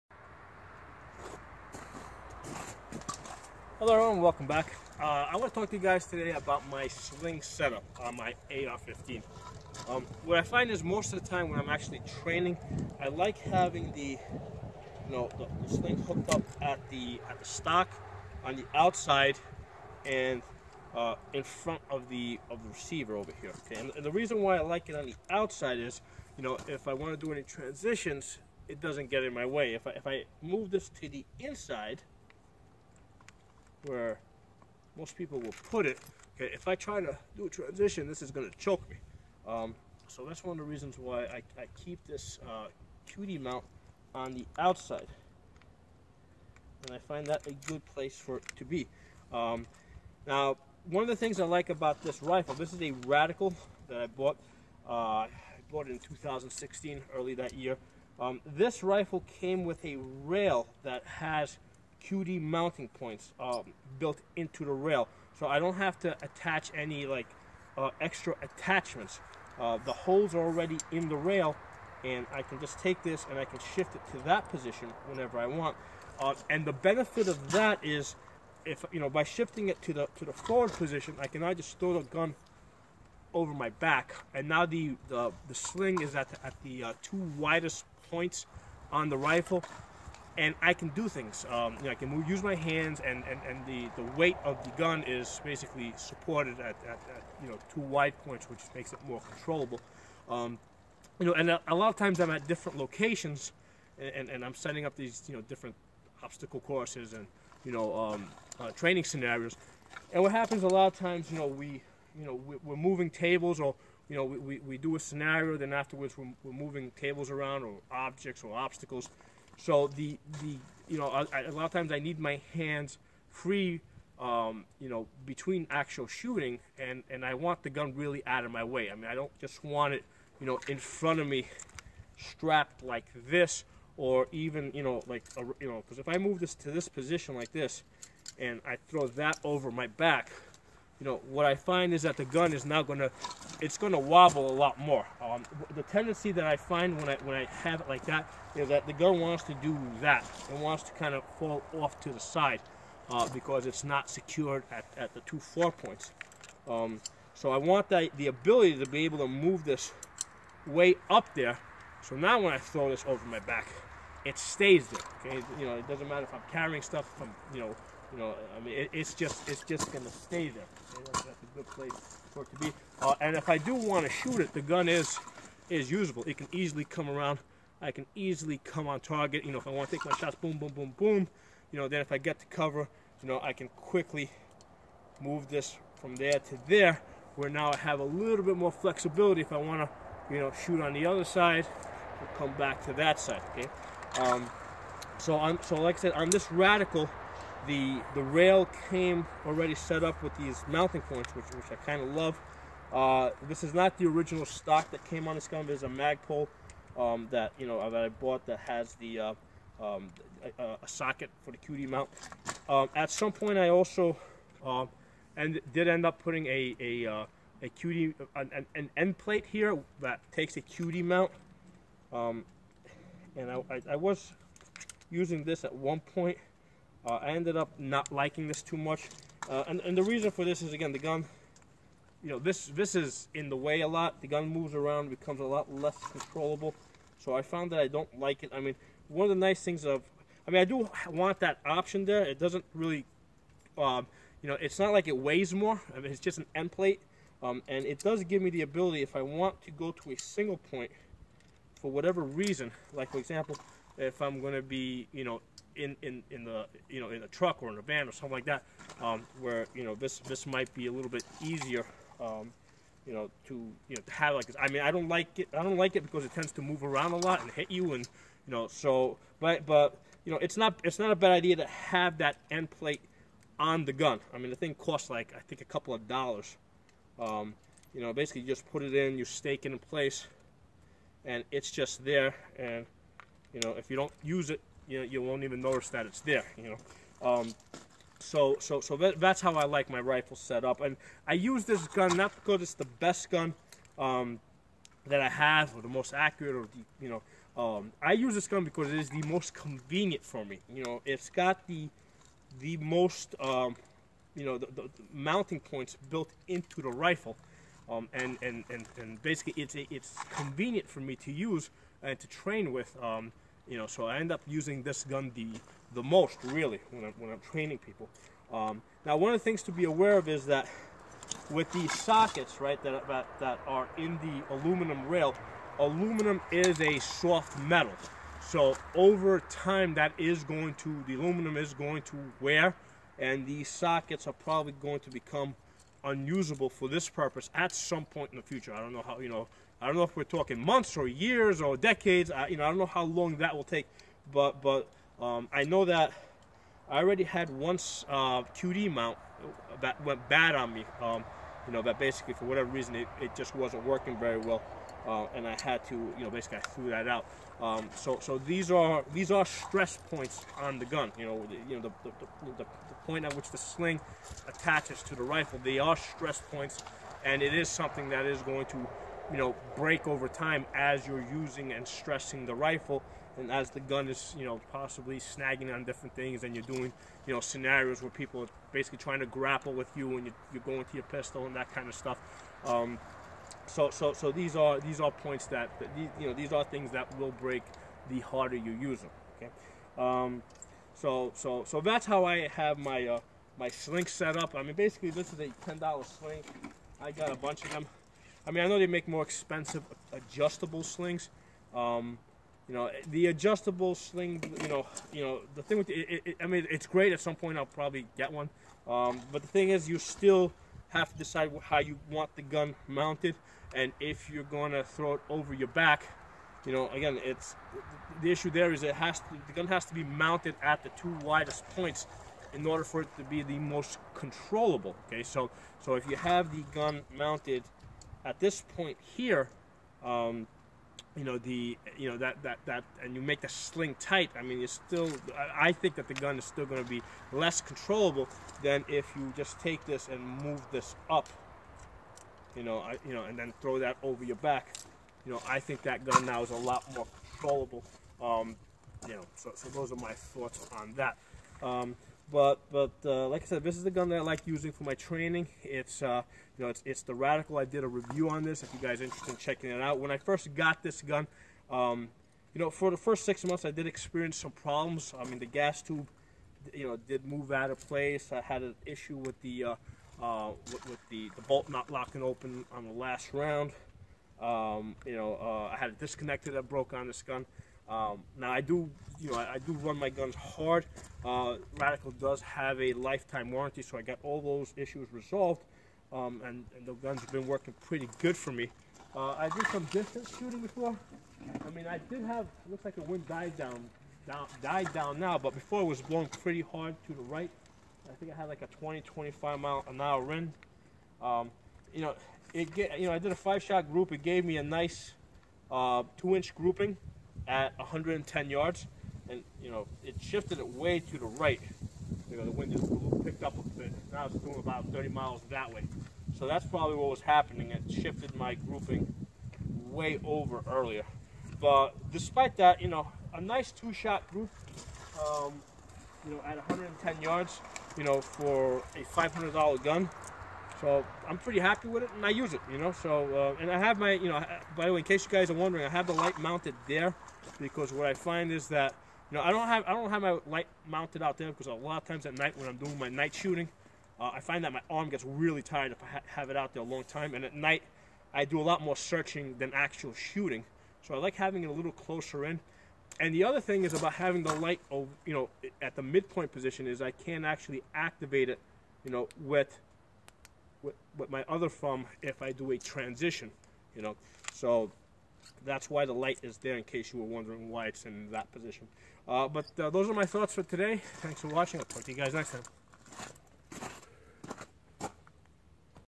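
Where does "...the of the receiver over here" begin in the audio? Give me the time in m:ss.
0:22.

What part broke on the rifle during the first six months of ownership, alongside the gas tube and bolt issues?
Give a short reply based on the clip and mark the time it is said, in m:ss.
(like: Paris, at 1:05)
disconnector, at 7:55.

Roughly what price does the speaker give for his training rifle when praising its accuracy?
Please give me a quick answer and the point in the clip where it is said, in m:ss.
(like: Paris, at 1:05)
$500, at 8:49.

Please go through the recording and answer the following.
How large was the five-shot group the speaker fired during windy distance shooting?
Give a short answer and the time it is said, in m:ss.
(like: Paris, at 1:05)
2 inches, at 8:26.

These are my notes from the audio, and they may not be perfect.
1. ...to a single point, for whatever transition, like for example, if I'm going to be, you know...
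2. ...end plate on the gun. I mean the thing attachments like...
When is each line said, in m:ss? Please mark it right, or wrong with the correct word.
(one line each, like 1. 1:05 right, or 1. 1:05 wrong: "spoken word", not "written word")
1. 4:09 wrong: "reason", not "transition"
2. 4:32 wrong: "costs", not "attachments".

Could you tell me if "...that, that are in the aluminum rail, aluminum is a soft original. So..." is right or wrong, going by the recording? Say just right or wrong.
wrong.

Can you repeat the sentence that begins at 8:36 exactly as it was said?
So that's probably what was happening.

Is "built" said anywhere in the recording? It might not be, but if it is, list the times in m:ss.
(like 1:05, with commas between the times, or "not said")
1:03, 5:06.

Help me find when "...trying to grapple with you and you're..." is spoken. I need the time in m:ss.
6:18.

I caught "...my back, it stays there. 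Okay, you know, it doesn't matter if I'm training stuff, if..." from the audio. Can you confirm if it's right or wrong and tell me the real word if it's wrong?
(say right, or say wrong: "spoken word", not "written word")
wrong: "carrying", not "training".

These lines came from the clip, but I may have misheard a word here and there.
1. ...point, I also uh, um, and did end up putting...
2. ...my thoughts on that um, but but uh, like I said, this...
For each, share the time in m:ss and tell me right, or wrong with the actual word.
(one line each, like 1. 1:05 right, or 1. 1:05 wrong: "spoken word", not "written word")
1. 3:33 right
2. 7:29 right.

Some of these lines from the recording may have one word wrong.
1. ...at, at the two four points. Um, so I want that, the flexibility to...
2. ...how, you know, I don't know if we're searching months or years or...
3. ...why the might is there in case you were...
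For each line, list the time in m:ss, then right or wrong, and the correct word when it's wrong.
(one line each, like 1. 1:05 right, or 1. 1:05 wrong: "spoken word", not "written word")
1. 2:34 wrong: "ability", not "flexibility"
2. 5:39 wrong: "talking", not "searching"
3. 9:25 wrong: "light", not "might".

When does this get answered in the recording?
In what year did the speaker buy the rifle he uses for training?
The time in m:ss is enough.
0:55.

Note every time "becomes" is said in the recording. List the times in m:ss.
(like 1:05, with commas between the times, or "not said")
3:55, 5:35.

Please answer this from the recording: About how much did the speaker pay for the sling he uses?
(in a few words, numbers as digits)
$10.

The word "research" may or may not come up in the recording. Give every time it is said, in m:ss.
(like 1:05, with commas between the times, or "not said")
not said.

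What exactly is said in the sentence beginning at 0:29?
If I if I move this to the inside where most people will put it.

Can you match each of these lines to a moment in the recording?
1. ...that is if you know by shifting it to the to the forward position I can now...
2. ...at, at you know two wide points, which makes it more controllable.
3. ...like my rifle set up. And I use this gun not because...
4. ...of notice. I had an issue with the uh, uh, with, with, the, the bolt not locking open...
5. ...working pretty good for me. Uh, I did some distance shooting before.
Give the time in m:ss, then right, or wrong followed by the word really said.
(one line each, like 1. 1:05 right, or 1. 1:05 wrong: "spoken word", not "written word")
1. 1:17 right
2. 1:36 right
3. 4:49 right
4. 7:47 wrong: "place", not "notice"
5. 8:07 right.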